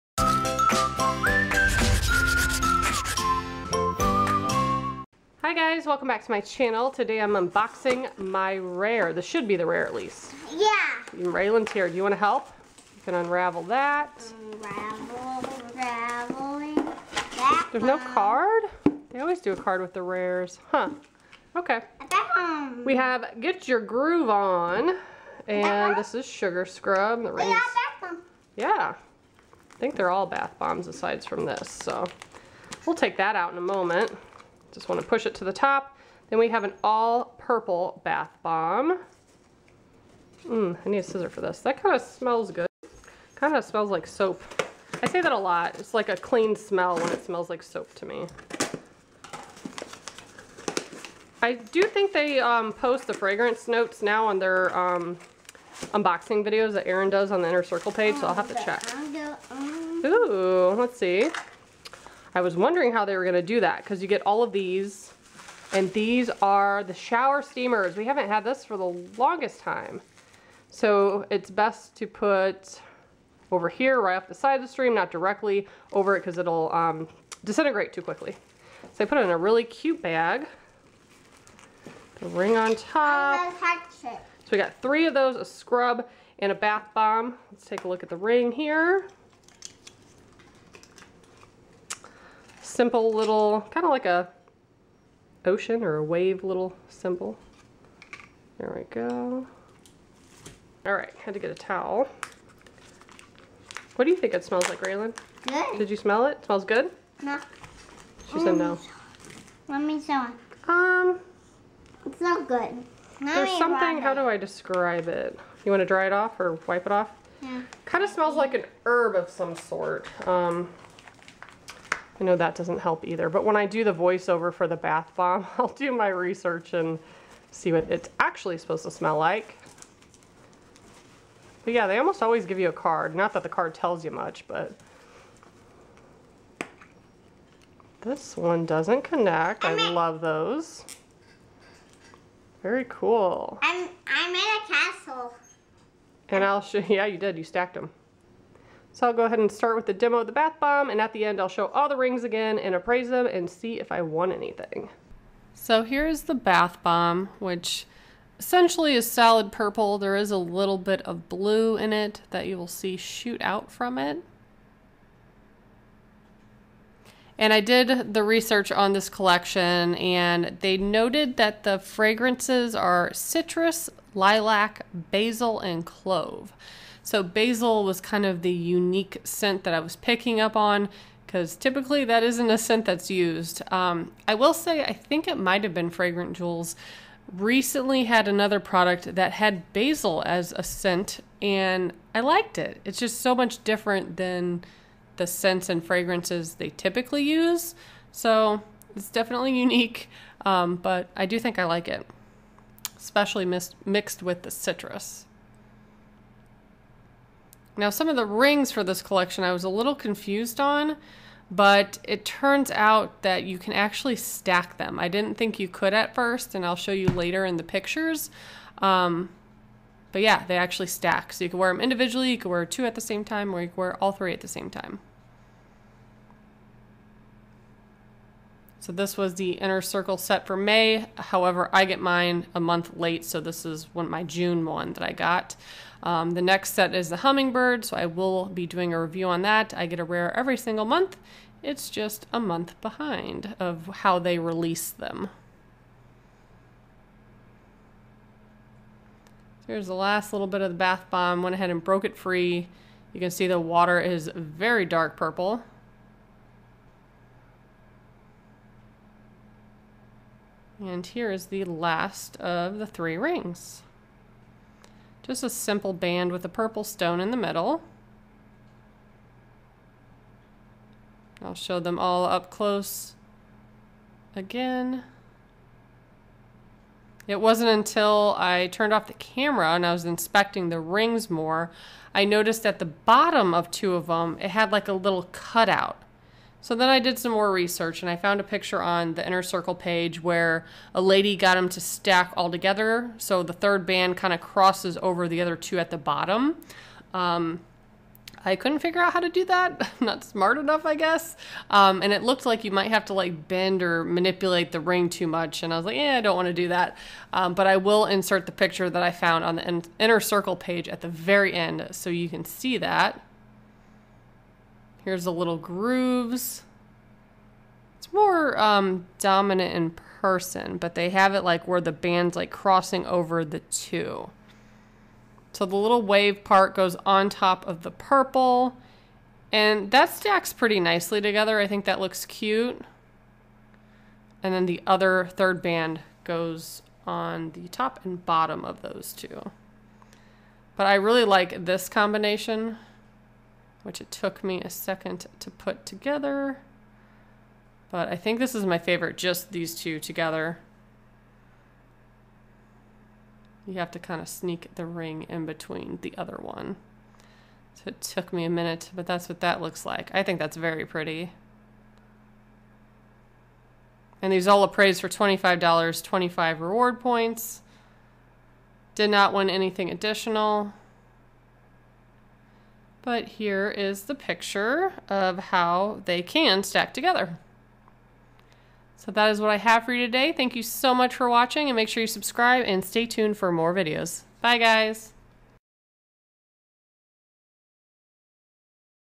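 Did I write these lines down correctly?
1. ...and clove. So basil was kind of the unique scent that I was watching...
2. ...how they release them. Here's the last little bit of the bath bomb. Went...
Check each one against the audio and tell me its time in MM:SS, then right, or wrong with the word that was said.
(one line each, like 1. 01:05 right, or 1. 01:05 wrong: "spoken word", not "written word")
1. 02:55 wrong: "picking", not "watching"
2. 04:03 right.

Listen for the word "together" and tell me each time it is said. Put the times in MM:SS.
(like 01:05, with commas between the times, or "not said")
04:52, 05:31, 05:45, 05:49, 06:16.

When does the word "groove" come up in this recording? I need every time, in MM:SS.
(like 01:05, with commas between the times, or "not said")
00:23, 05:15.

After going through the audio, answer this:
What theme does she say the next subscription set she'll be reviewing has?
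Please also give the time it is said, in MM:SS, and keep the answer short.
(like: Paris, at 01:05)
Hummingbird, at 03:57.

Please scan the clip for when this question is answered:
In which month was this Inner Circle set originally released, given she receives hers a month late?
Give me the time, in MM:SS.
03:50.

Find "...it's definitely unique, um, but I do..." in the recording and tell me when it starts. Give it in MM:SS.
03:18.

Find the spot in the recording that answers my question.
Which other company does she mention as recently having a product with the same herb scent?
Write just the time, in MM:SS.
03:05.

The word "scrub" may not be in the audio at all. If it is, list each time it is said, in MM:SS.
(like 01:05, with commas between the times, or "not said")
00:26, 01:25.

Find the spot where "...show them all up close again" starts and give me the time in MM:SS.
04:31.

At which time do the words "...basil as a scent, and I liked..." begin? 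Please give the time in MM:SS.
03:09.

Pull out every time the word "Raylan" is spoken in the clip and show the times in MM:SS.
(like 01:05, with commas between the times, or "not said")
00:11, 01:44.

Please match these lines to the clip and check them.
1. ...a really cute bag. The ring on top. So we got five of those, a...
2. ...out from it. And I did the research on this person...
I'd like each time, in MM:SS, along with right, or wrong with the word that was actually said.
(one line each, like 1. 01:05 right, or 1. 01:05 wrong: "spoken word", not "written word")
1. 01:19 wrong: "three", not "five"
2. 02:43 wrong: "collection", not "person".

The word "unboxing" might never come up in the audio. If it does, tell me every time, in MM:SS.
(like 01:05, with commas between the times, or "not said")
00:07, 00:55.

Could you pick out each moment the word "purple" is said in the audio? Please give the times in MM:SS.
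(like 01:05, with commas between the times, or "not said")
00:37, 02:39, 04:15, 04:26, 05:27.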